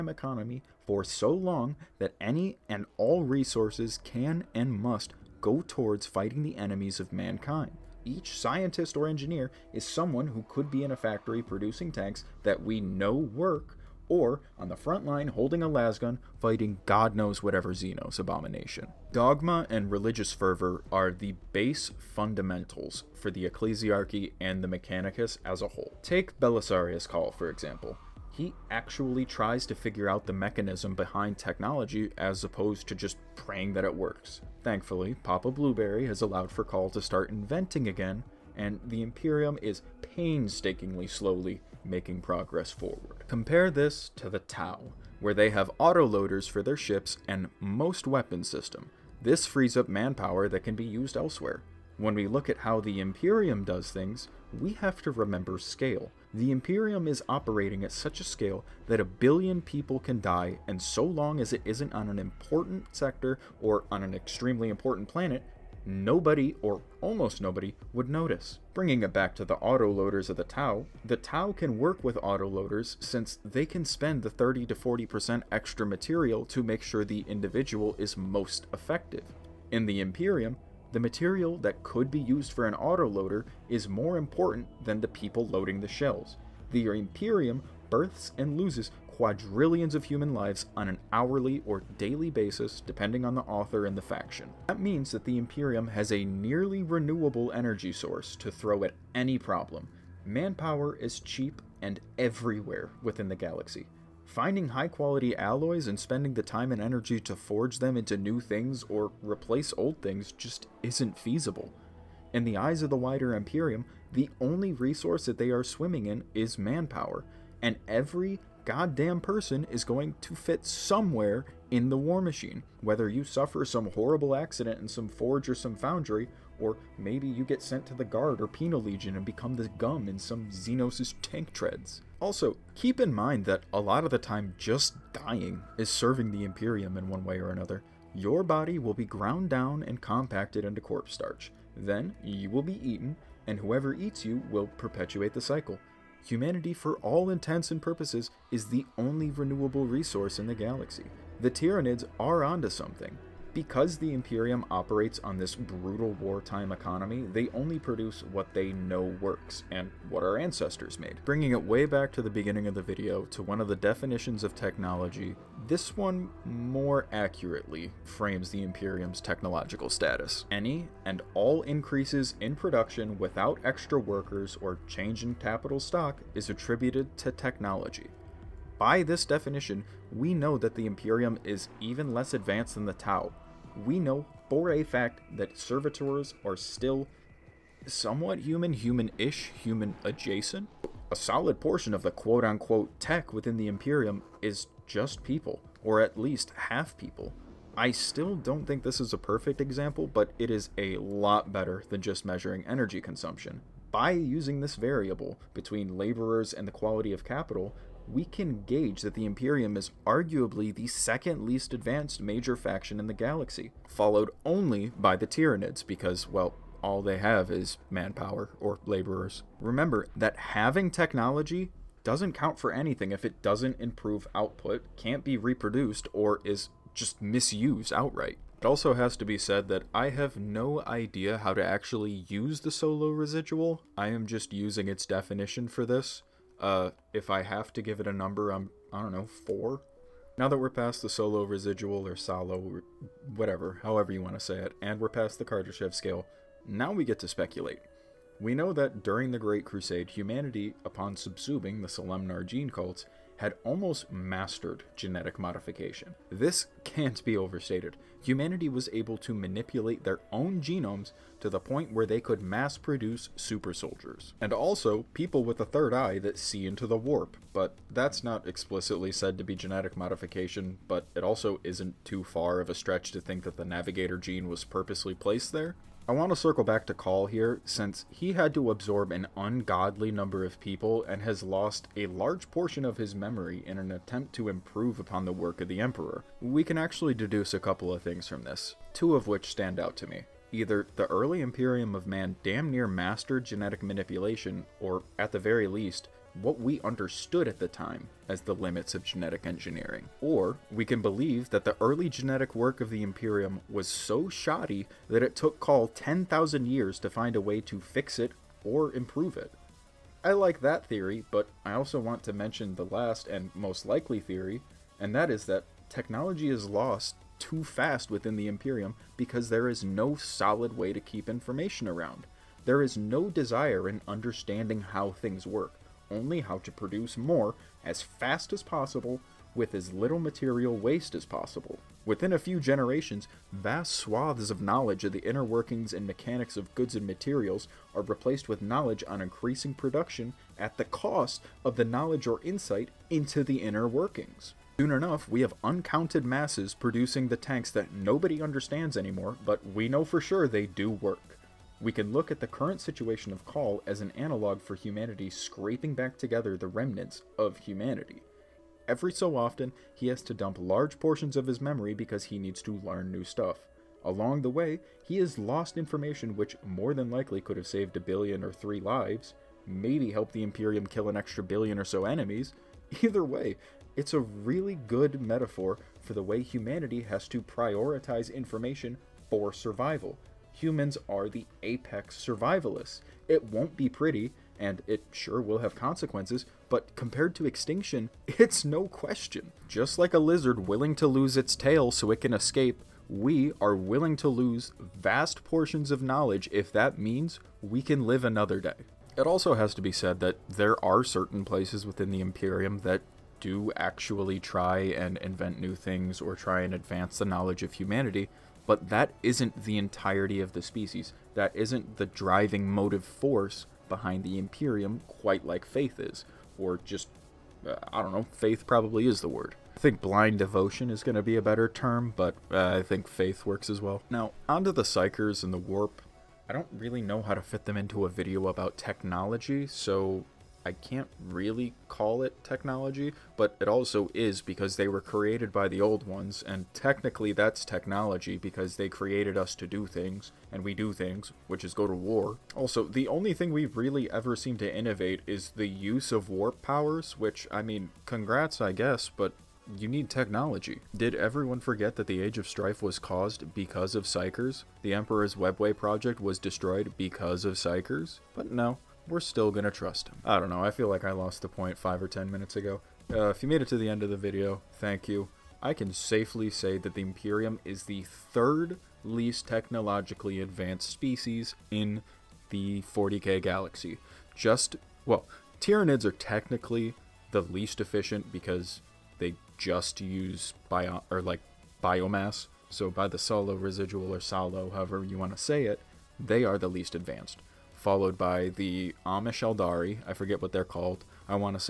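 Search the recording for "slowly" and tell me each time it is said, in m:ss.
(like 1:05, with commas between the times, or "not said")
0:41.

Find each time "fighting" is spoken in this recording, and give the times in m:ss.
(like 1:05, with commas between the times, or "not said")
0:06, 0:16.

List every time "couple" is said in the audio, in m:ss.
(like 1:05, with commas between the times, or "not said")
4:47.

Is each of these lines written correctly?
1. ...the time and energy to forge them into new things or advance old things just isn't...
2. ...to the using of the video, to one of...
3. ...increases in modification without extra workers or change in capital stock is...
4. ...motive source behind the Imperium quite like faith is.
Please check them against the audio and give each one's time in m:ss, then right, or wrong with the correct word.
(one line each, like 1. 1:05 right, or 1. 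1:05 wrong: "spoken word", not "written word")
1. 1:46 wrong: "replace", not "advance"
2. 2:42 wrong: "beginning", not "using"
3. 2:51 wrong: "production", not "modification"
4. 6:52 wrong: "force", not "source".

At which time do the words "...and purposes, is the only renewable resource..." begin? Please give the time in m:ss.
2:27.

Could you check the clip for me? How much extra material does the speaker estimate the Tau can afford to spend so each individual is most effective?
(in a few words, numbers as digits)
30 to 40%.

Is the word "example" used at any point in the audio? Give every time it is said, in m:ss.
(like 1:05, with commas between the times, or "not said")
0:27, 3:19.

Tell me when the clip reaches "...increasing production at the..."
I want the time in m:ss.
5:39.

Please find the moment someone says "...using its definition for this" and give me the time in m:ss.
3:54.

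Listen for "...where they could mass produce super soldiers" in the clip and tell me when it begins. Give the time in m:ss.
4:21.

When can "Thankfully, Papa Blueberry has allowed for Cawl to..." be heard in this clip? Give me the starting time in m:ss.
0:34.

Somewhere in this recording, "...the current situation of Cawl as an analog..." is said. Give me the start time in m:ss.
5:52.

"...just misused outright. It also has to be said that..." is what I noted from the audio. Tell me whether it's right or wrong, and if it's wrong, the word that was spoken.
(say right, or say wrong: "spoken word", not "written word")
right.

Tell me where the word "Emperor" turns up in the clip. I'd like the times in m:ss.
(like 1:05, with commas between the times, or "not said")
4:45, 7:34.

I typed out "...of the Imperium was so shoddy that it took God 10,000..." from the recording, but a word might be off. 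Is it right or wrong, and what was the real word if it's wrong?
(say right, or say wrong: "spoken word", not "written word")
wrong: "Cawl", not "God".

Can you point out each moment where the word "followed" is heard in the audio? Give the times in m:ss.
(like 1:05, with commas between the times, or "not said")
3:33, 8:07.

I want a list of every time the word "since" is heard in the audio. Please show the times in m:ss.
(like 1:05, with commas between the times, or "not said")
1:13, 4:37.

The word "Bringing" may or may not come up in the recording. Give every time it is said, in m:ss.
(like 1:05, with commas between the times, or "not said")
1:08, 2:41.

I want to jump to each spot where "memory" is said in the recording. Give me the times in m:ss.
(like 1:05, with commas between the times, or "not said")
4:43, 6:01.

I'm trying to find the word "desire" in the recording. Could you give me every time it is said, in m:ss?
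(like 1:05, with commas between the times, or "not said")
5:23.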